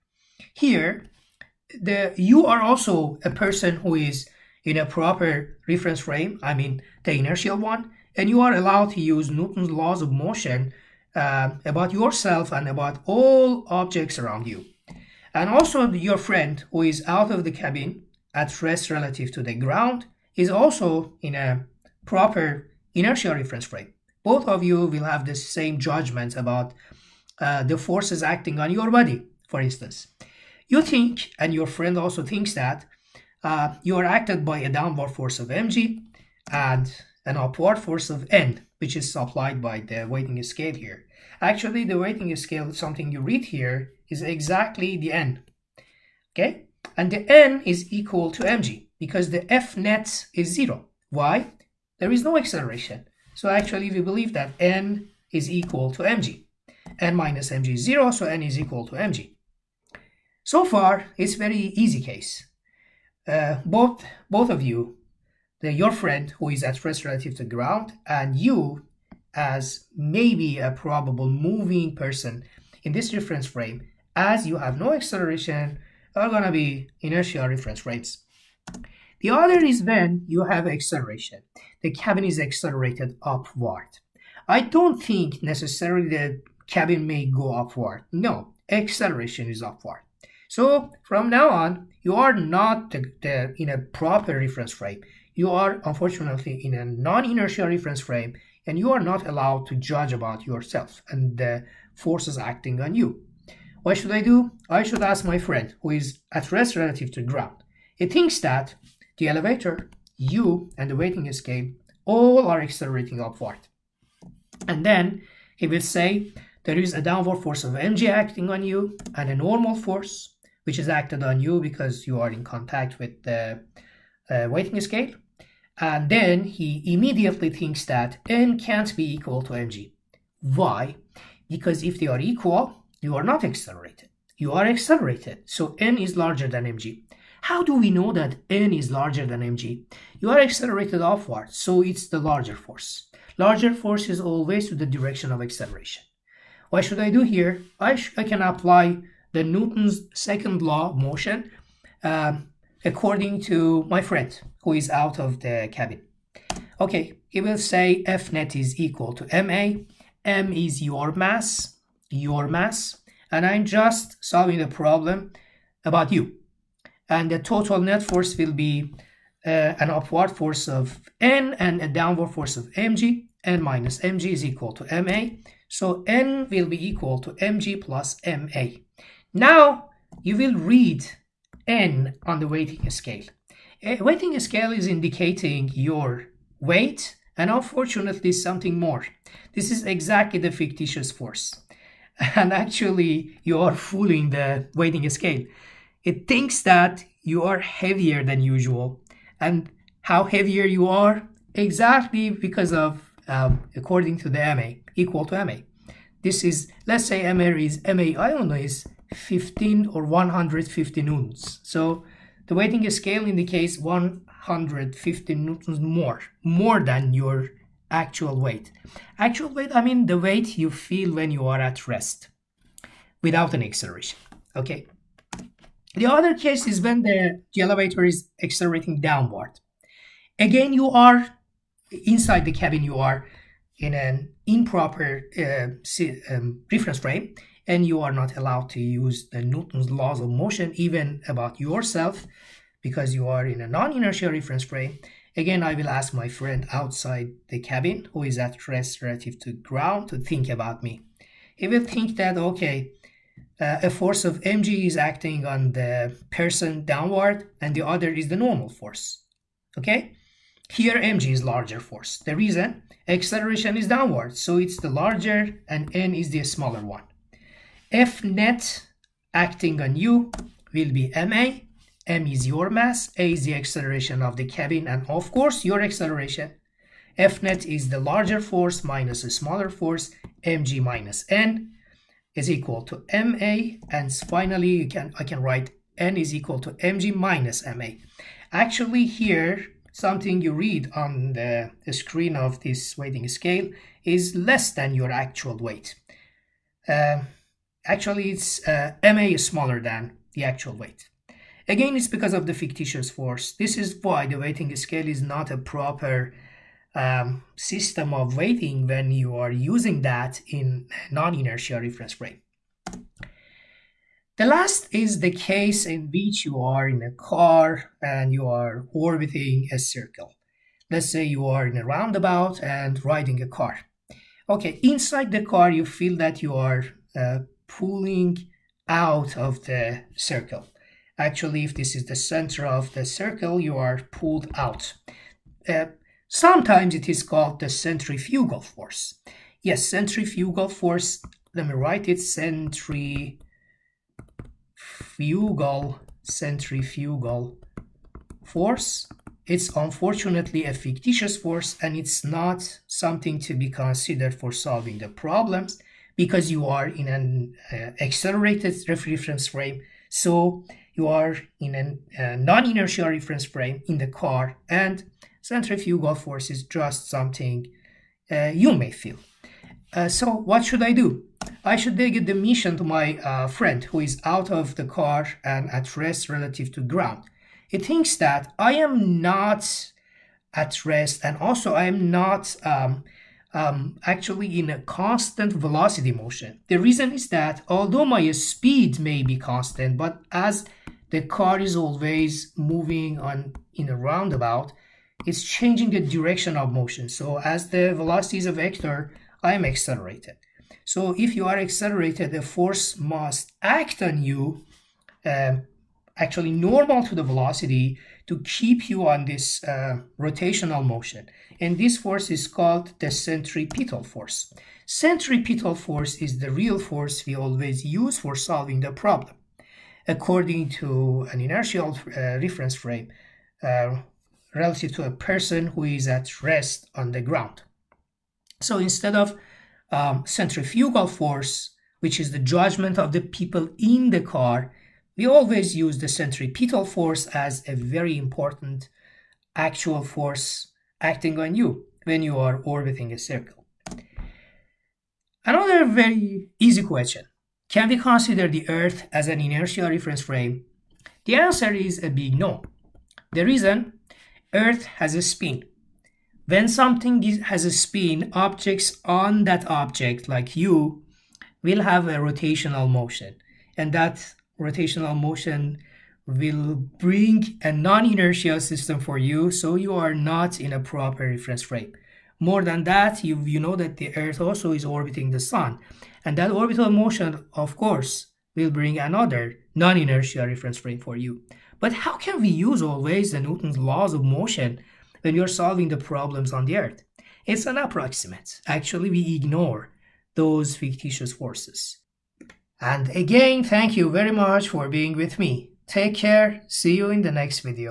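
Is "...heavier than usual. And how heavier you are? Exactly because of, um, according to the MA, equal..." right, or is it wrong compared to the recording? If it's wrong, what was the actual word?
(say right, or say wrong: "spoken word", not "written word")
right.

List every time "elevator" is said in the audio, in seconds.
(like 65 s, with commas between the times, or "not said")
109 s, 227 s.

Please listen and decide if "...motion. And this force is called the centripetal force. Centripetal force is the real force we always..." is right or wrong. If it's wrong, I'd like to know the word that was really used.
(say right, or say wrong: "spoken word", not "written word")
right.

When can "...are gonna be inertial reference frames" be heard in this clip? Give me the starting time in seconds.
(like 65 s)
76 s.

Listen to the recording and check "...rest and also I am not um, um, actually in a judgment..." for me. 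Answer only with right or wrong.
wrong.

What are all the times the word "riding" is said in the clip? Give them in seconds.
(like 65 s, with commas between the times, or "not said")
323 s.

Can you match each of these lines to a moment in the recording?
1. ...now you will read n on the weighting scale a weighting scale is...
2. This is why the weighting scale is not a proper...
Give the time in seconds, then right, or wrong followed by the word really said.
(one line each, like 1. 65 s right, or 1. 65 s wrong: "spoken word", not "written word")
1. 179 s right
2. 303 s right.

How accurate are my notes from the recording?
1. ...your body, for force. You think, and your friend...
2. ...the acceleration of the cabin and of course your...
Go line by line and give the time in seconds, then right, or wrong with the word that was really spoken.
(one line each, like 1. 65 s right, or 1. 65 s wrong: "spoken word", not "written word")
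1. 28 s wrong: "instance", not "force"
2. 273 s right.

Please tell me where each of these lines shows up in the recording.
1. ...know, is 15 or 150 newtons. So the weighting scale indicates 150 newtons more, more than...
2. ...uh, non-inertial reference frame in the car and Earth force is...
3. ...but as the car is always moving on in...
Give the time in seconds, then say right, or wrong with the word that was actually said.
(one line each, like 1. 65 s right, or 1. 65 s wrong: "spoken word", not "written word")
1. 208 s right
2. 362 s wrong: "Centrifugal", not "Earth"
3. 389 s right.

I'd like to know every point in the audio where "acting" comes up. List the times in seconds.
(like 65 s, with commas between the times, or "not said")
28 s, 102 s, 118 s, 254 s, 269 s, 441 s.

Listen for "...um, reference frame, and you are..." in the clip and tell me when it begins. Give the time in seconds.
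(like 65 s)
236 s.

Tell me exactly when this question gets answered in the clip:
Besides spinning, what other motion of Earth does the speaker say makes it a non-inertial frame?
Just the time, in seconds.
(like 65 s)
474 s.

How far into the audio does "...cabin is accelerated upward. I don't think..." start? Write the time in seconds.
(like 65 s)
81 s.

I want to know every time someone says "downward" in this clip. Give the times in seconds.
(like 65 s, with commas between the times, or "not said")
34 s, 117 s, 171 s, 228 s, 256 s, 263 s.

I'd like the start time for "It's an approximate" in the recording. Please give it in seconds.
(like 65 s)
487 s.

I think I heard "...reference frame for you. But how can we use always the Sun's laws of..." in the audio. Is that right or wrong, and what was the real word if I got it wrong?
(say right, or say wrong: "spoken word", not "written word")
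wrong: "Newton", not "Sun".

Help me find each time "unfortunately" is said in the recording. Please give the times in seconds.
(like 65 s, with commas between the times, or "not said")
95 s, 187 s, 349 s.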